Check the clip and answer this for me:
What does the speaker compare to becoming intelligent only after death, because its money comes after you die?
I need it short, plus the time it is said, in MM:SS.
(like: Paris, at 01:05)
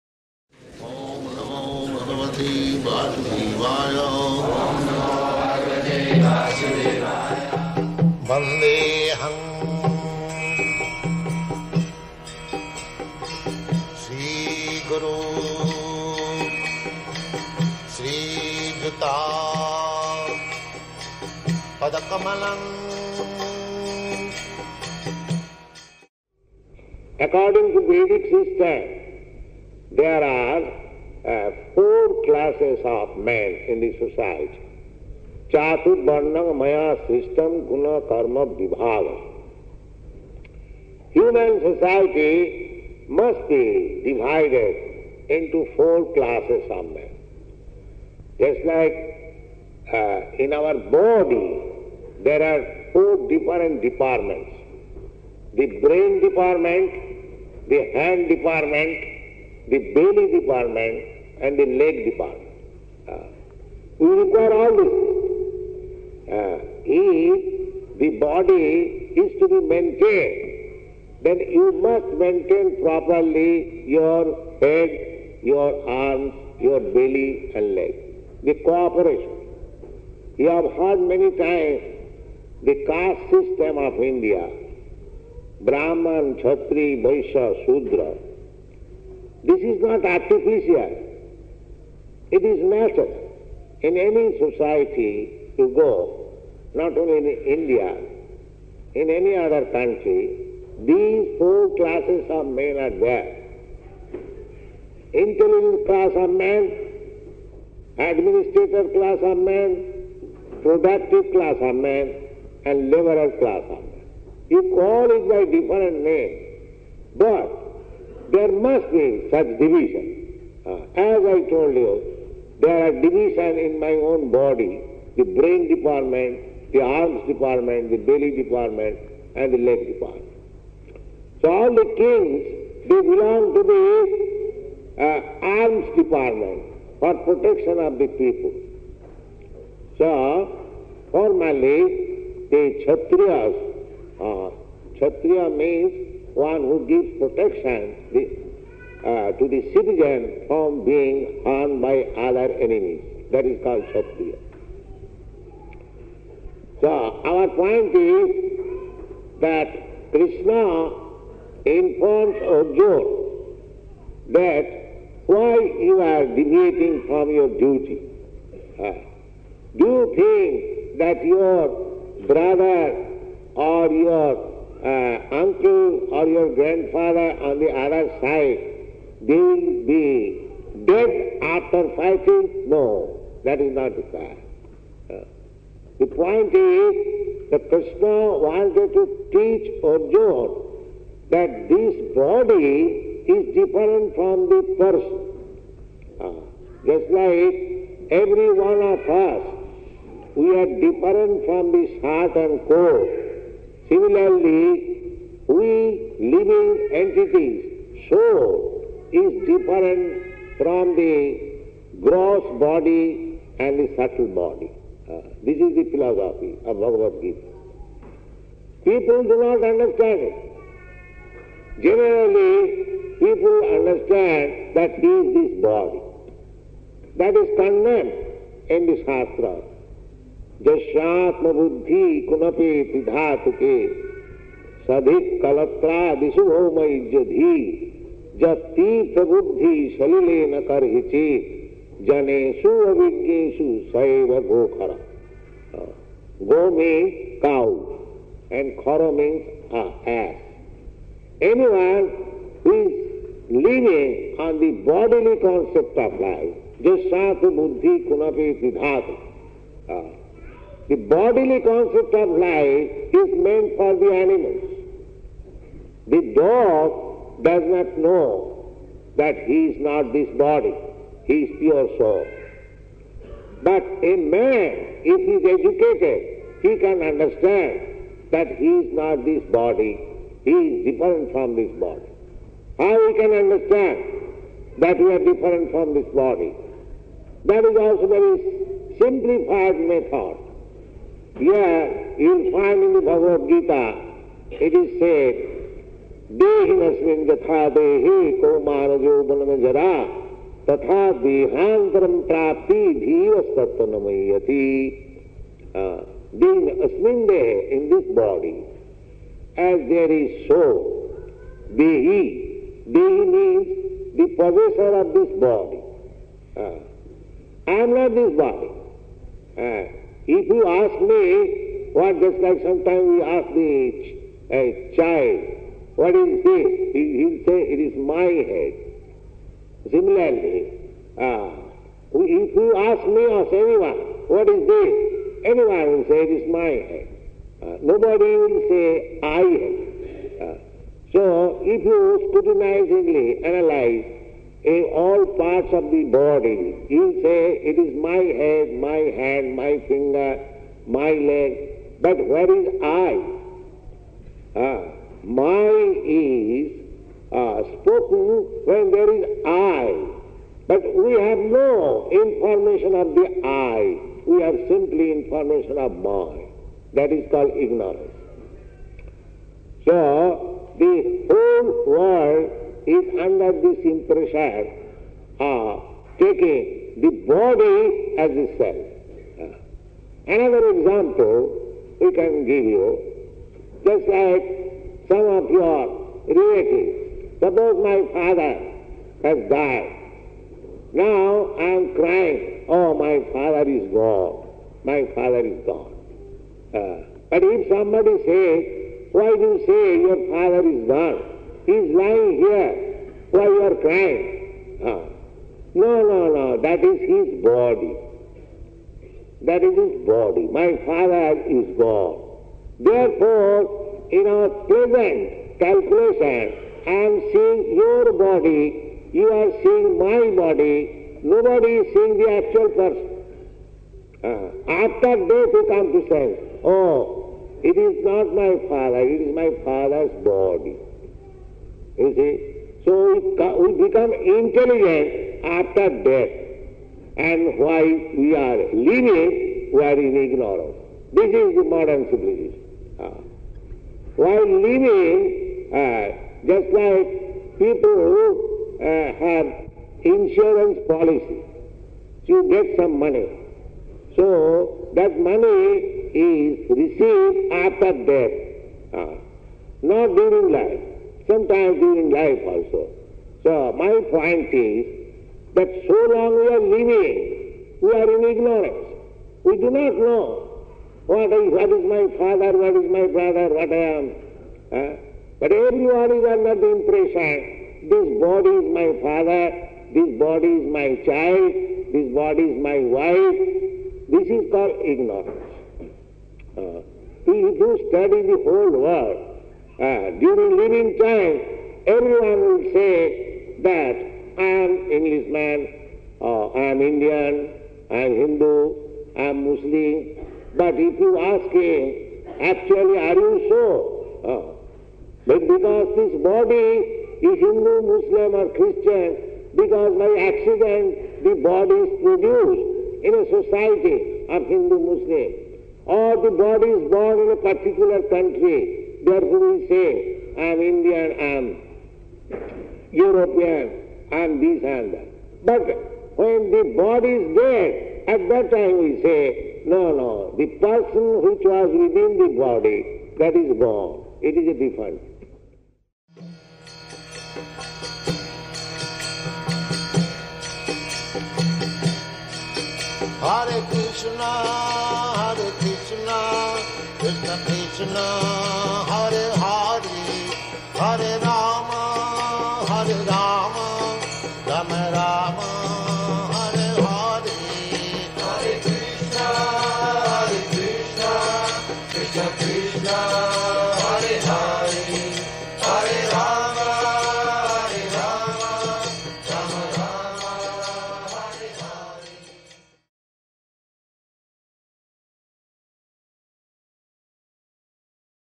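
insurance policy, at 07:30.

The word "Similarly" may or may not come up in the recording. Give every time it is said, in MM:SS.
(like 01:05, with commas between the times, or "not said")
03:23, 05:29.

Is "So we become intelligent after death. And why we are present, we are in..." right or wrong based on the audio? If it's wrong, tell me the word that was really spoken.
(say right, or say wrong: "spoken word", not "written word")
wrong: "lenient", not "present".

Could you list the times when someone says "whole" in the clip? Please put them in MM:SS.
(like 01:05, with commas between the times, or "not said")
06:11, 08:08.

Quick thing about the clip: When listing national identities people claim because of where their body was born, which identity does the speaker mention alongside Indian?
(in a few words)
European.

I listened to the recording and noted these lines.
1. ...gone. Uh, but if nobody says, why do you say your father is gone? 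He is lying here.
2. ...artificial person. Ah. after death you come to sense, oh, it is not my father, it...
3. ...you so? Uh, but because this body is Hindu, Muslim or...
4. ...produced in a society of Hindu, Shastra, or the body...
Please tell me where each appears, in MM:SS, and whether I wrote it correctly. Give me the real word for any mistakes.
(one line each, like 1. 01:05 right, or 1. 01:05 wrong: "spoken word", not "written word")
1. 06:35 wrong: "somebody", not "nobody"
2. 07:02 wrong: "actual", not "artificial"
3. 08:23 right
4. 08:32 wrong: "Muslim", not "Shastra".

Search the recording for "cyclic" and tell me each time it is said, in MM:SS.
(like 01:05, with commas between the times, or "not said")
not said.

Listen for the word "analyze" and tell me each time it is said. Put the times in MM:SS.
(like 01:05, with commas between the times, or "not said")
05:43.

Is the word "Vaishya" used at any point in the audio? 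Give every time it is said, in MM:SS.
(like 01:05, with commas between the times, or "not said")
01:27.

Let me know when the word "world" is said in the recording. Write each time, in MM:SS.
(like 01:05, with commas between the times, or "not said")
06:11, 08:08.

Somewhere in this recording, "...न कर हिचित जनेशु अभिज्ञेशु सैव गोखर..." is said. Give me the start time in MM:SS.
04:00.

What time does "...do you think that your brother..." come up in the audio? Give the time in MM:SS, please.
02:49.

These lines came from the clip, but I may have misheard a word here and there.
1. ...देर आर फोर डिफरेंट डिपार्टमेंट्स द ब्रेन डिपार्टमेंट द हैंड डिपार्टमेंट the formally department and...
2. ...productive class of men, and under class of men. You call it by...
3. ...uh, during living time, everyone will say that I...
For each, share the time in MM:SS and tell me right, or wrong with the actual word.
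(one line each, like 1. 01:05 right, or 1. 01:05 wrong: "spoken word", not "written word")
1. 00:52 wrong: "belly", not "formally"
2. 01:50 wrong: "laborer", not "under"
3. 08:09 right.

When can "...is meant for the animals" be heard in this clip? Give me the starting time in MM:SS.
04:23.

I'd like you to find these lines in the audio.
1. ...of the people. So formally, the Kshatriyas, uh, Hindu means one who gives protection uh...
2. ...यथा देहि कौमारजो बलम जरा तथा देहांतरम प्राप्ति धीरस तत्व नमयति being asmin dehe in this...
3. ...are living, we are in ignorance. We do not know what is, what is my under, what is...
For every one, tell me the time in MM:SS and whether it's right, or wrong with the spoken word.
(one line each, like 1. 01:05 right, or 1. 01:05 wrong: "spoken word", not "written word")
1. 02:17 wrong: "Kshatriya", not "Hindu"
2. 04:57 right
3. 07:46 wrong: "father", not "under".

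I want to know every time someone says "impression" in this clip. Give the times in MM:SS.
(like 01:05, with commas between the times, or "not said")
06:13, 07:56.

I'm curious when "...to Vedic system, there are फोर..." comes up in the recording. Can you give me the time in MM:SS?
00:27.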